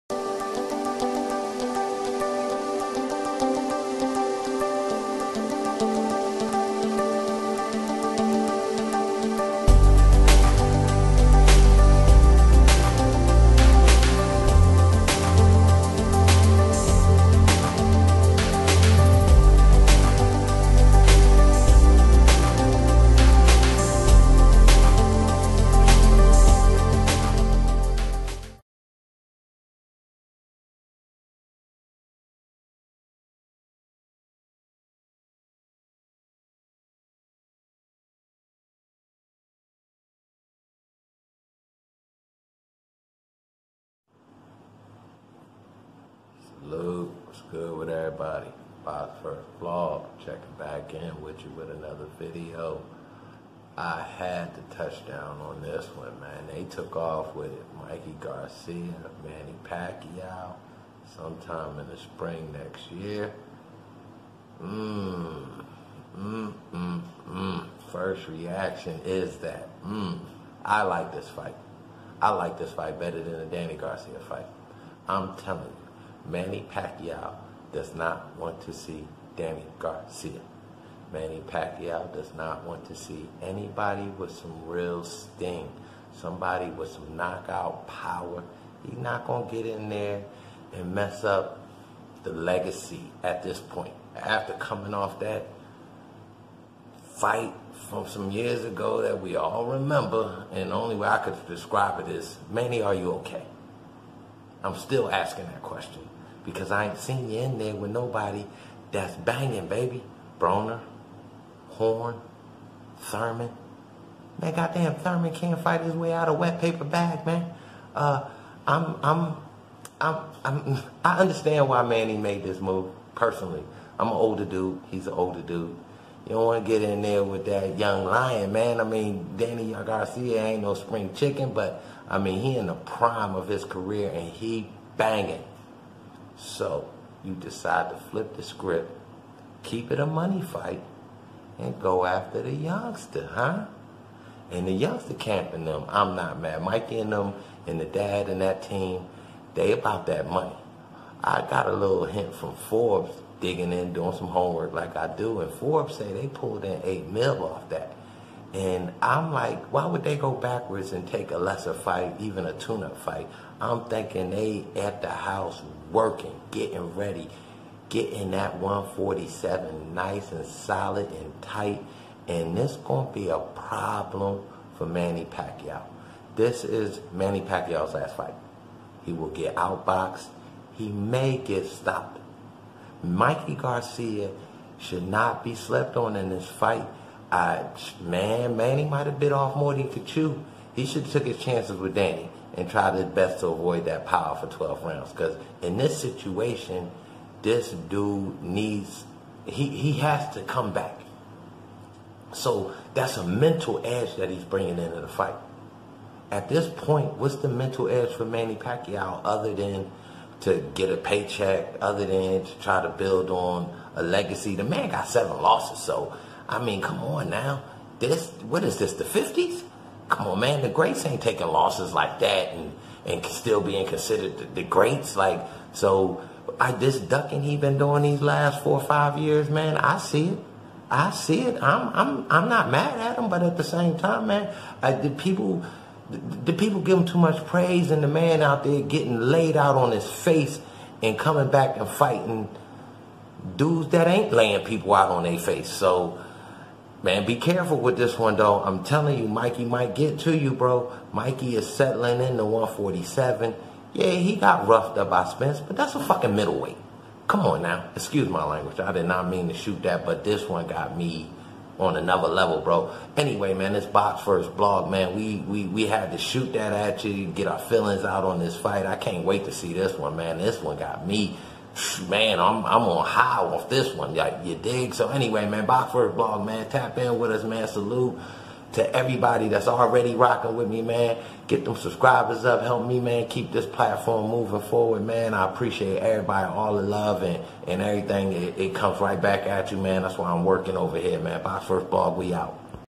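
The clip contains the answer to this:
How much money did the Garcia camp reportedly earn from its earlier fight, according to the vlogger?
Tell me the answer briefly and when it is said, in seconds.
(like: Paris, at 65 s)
8 mil, at 156 s.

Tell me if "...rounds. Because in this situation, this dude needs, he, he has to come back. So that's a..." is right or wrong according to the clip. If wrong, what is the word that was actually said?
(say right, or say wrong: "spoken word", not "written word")
right.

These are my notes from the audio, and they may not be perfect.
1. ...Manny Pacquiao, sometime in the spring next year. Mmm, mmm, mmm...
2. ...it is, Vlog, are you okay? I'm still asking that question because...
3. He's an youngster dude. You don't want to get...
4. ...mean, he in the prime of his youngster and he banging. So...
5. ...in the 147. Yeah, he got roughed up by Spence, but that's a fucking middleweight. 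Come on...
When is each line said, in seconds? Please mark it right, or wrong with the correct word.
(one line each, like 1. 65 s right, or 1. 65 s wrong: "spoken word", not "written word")
1. 59 s right
2. 101 s wrong: "Manny", not "Vlog"
3. 124 s wrong: "older", not "youngster"
4. 132 s wrong: "career", not "youngster"
5. 252 s right.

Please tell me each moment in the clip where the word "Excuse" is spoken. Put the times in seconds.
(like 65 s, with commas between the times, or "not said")
257 s.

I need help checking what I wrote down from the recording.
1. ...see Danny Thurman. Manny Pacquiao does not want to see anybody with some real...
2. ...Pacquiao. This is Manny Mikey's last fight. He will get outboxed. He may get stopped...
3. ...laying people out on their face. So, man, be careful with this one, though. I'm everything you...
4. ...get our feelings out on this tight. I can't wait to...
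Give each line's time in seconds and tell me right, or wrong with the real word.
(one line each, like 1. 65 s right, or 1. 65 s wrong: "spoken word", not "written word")
1. 78 s wrong: "Garcia", not "Thurman"
2. 175 s wrong: "Pacquiao", not "Mikey"
3. 244 s wrong: "telling", not "everything"
4. 267 s wrong: "fight", not "tight".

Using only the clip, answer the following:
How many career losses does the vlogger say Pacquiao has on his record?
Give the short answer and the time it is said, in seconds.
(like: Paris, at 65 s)
7, at 215 s.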